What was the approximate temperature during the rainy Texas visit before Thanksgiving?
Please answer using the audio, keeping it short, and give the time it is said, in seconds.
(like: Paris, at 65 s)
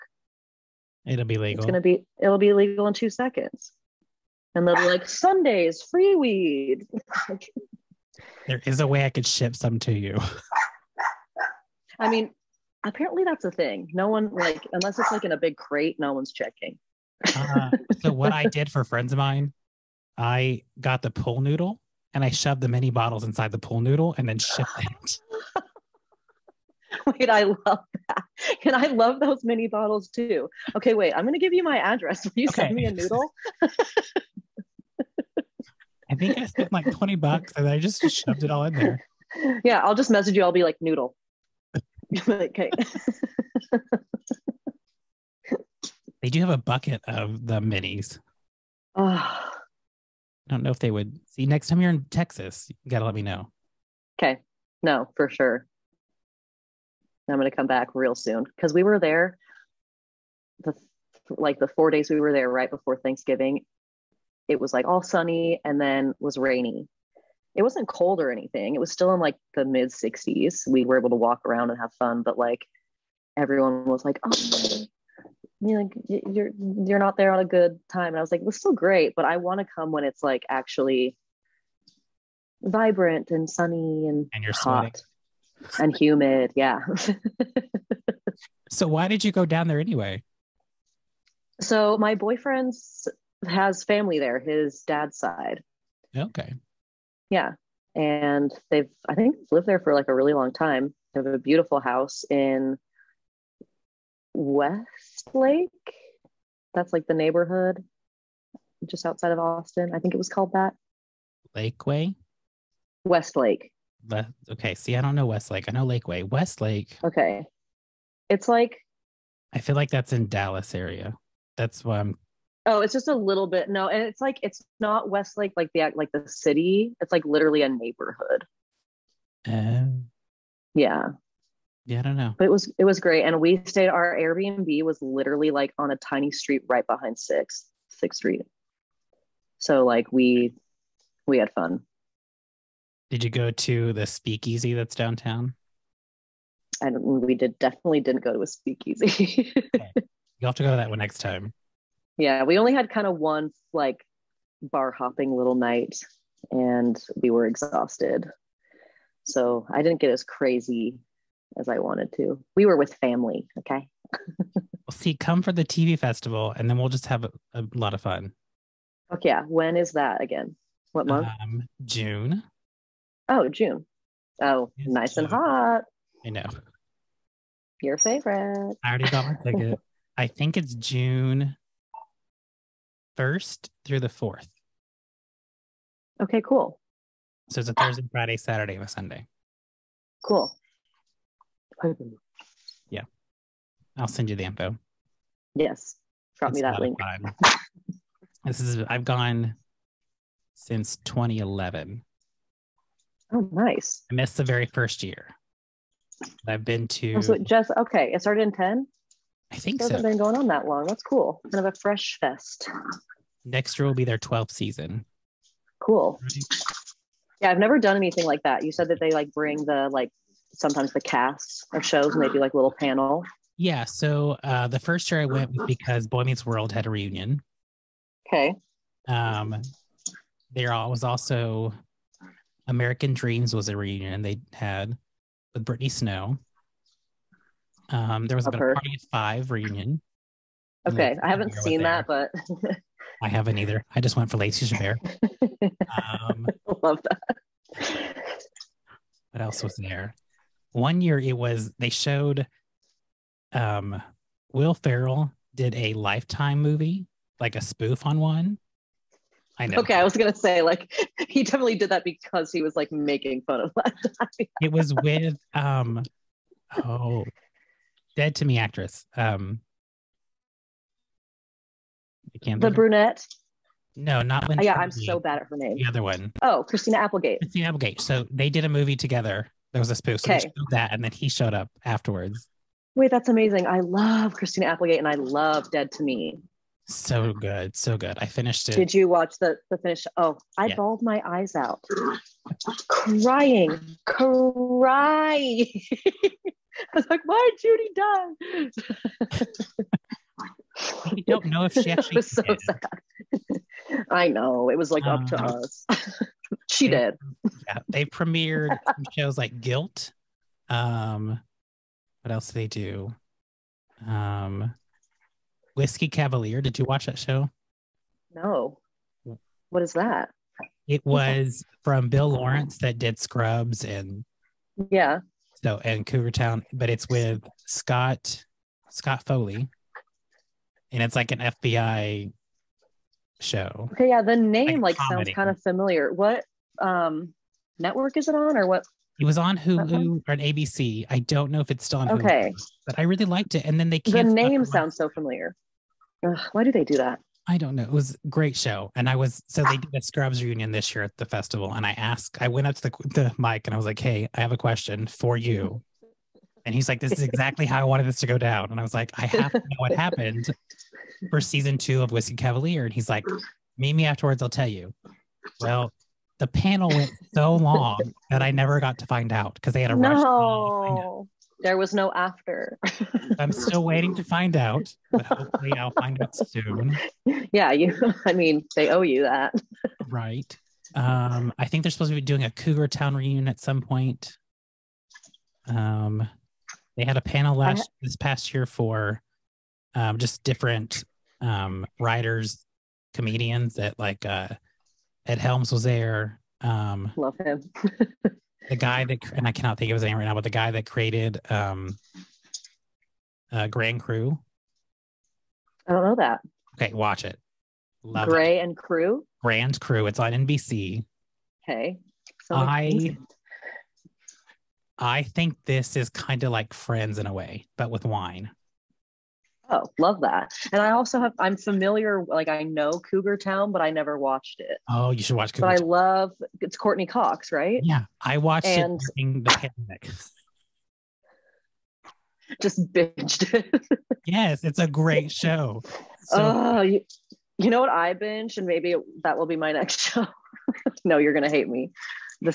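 mid 60s, at 69 s.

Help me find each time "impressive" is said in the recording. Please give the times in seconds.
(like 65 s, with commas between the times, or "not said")
not said.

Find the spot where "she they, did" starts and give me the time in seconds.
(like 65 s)
306 s.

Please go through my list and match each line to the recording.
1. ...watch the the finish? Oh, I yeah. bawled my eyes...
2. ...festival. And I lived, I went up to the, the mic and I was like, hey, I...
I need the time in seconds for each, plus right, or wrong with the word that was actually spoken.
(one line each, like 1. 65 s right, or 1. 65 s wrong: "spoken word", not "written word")
1. 289 s right
2. 351 s wrong: "asked", not "lived".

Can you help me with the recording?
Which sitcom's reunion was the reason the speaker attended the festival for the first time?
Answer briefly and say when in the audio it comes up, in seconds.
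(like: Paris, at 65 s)
Boy Meets World, at 226 s.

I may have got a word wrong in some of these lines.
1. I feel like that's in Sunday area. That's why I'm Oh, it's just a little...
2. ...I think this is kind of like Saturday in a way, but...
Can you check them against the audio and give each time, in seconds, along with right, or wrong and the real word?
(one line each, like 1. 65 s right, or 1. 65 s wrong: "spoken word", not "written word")
1. 119 s wrong: "Dallas", not "Sunday"
2. 414 s wrong: "Friends", not "Saturday".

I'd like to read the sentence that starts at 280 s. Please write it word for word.
that, and then he showed up afterwards.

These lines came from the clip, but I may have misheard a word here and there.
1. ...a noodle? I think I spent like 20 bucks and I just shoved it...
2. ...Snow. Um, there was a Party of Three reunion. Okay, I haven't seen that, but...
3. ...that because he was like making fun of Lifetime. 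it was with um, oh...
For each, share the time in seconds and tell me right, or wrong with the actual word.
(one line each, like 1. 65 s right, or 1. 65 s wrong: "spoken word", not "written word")
1. 32 s right
2. 235 s wrong: "Five", not "Three"
3. 261 s right.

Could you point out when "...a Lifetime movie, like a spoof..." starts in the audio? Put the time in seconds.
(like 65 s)
255 s.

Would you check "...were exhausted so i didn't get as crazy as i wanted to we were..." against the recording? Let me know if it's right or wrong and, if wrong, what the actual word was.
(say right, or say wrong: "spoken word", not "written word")
right.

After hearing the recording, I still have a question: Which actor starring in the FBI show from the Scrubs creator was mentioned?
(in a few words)
Scott Foley.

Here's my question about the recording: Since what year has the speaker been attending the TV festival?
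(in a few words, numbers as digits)
2011.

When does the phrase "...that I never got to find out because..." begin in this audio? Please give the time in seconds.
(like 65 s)
368 s.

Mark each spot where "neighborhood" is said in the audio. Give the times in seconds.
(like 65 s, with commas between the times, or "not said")
107 s, 127 s.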